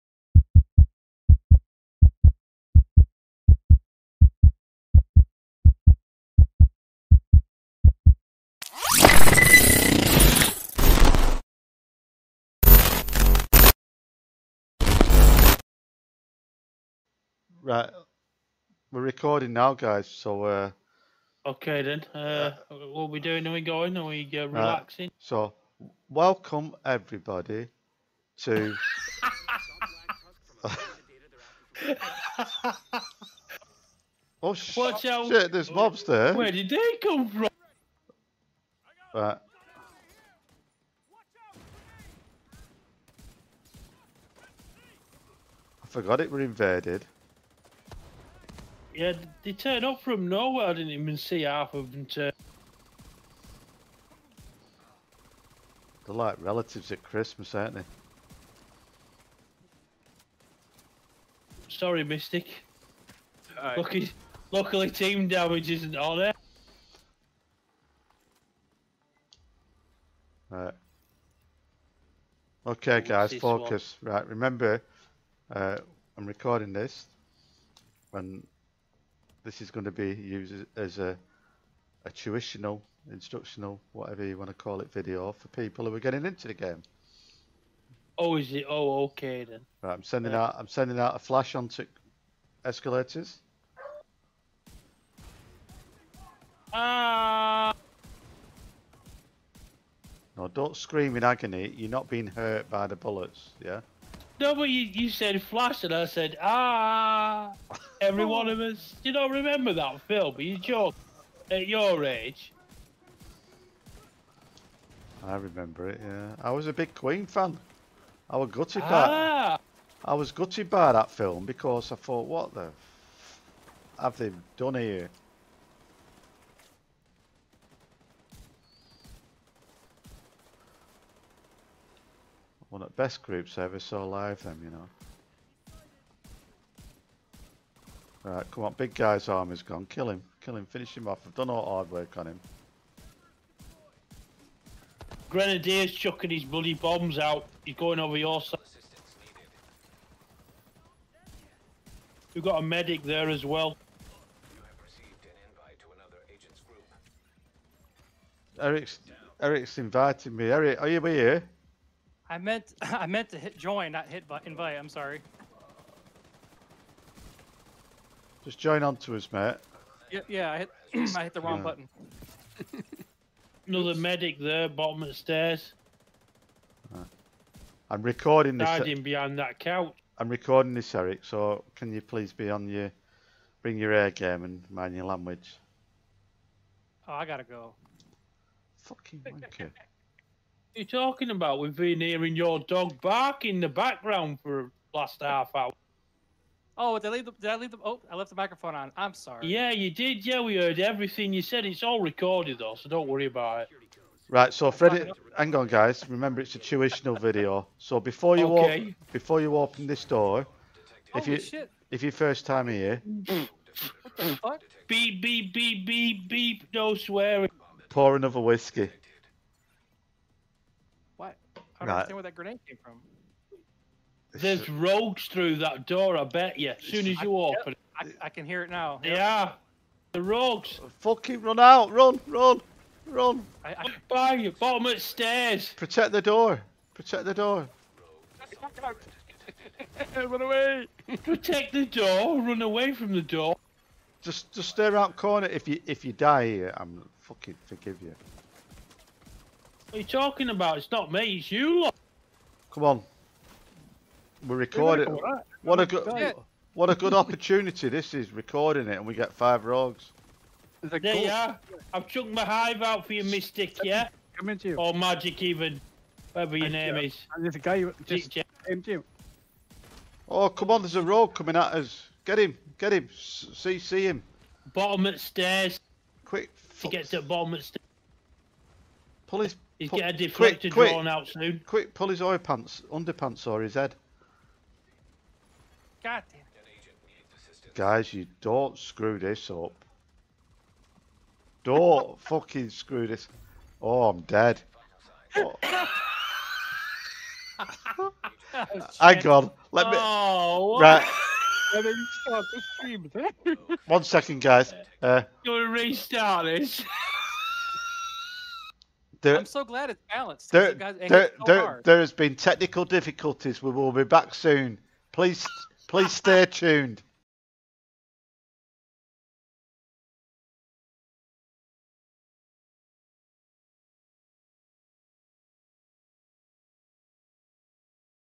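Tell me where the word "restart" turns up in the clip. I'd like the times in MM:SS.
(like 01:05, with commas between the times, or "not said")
05:05.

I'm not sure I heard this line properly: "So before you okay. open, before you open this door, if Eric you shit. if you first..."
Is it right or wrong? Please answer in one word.
wrong.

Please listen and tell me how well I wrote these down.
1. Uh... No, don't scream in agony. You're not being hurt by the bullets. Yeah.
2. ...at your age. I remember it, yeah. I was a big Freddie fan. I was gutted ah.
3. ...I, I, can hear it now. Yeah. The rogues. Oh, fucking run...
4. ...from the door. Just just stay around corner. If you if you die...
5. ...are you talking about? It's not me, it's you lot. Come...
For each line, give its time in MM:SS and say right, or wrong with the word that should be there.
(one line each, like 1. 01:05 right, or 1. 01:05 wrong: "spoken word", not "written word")
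1. 01:37 right
2. 01:51 wrong: "Queen", not "Freddie"
3. 03:48 right
4. 04:02 right
5. 04:09 right.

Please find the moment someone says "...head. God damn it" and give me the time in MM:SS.
04:43.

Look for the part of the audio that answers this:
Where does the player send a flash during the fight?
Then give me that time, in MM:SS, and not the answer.
01:31.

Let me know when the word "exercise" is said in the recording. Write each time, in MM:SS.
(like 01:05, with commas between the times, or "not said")
not said.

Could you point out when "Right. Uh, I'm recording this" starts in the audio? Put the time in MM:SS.
02:56.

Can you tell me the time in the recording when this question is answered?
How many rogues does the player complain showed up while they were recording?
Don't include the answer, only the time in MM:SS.
04:19.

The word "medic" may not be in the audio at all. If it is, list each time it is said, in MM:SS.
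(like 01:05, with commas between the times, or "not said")
02:32, 02:53.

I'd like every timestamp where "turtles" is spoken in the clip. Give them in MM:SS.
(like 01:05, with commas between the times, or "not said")
not said.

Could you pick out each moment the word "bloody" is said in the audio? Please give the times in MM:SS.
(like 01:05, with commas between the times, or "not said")
02:26.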